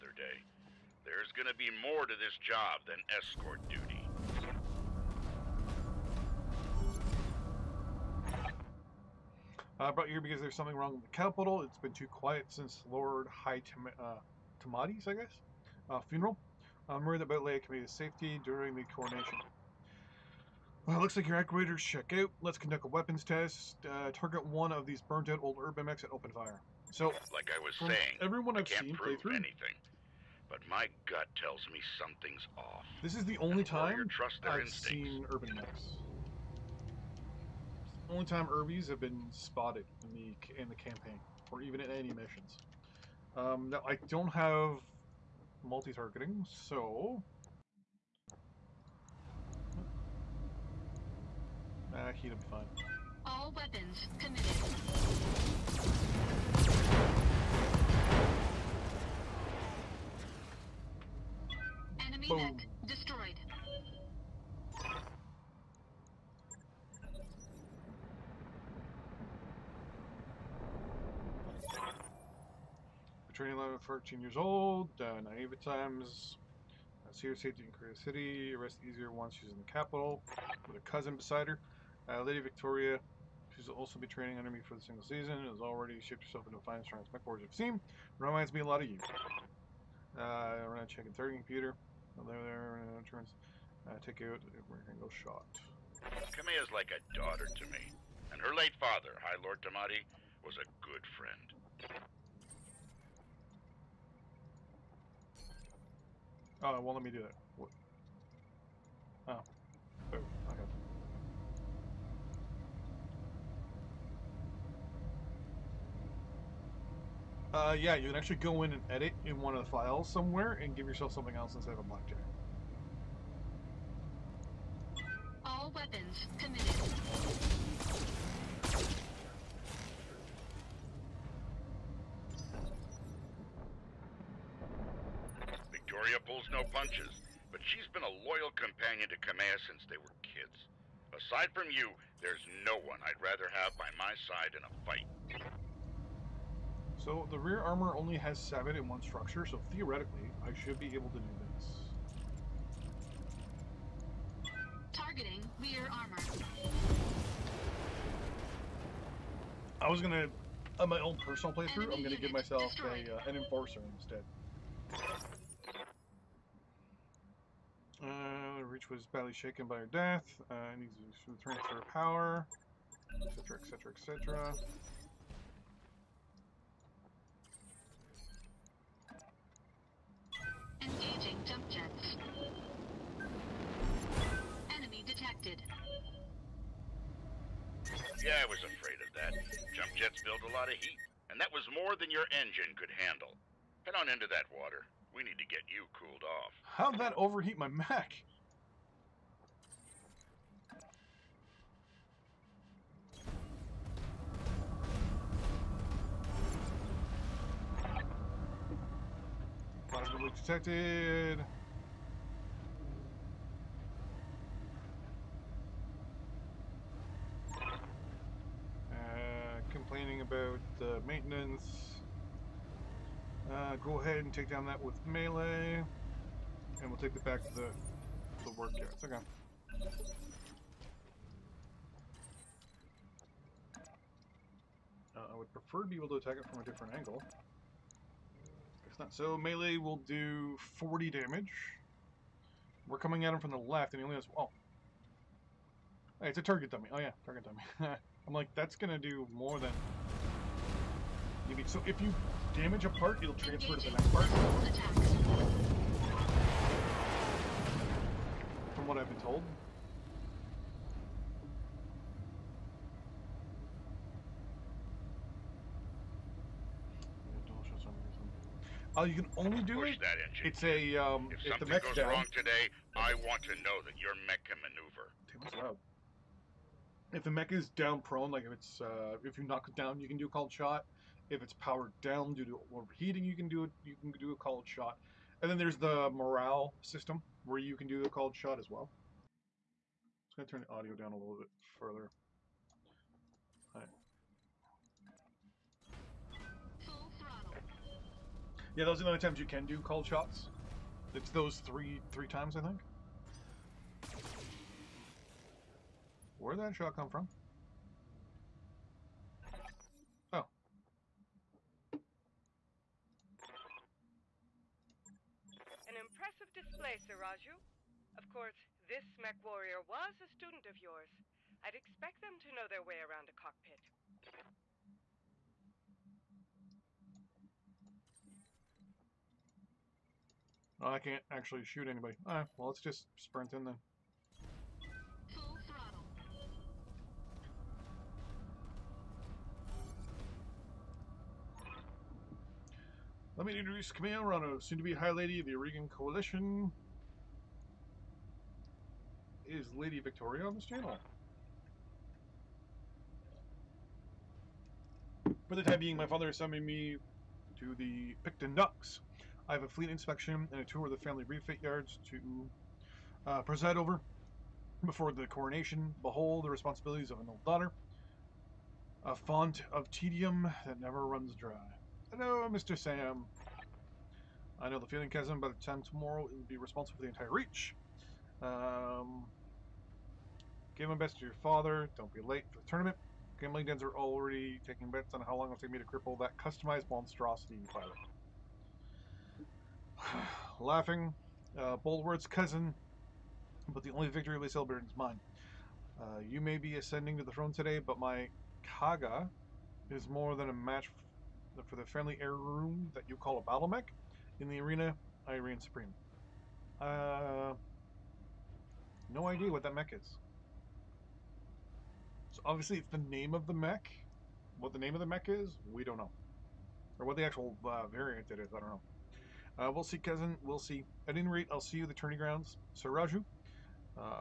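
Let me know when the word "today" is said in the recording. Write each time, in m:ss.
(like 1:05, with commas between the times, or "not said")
4:32, 6:37.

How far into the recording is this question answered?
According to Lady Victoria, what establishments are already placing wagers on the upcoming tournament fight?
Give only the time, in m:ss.
6:23.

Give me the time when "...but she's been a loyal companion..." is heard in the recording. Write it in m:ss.
2:17.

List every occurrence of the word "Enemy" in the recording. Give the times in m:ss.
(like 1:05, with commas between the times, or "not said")
2:41, 3:04.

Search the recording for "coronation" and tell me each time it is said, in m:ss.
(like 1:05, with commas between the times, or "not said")
0:18, 6:05.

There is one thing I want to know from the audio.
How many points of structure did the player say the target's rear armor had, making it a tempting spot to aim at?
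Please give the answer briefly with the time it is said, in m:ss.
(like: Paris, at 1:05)
7, at 2:28.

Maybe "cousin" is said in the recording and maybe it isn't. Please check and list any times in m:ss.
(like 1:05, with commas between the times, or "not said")
1:20, 6:32, 6:59.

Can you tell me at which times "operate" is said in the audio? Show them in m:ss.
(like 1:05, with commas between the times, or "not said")
not said.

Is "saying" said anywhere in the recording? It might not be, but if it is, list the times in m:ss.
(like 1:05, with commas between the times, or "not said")
0:27.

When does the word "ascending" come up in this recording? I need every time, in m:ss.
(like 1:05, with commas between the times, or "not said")
6:36.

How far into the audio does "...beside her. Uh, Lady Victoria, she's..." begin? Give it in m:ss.
1:21.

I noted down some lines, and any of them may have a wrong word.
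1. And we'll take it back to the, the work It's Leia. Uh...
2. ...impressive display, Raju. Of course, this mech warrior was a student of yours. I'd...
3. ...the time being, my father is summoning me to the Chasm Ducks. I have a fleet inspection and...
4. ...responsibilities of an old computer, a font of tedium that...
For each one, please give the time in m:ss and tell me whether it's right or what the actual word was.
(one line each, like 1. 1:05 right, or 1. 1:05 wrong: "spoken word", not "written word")
1. 3:46 wrong: "Okay", not "Leia"
2. 5:15 right
3. 5:55 wrong: "Picton", not "Chasm"
4. 6:06 wrong: "daughter", not "computer".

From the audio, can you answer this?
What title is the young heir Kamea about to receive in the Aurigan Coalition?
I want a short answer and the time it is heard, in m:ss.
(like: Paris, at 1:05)
High Lady, at 5:44.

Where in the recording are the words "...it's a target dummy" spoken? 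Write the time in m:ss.
4:06.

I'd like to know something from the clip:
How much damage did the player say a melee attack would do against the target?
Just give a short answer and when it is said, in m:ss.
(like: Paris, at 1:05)
40, at 4:00.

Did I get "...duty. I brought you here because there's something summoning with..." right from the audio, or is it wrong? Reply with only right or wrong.
wrong.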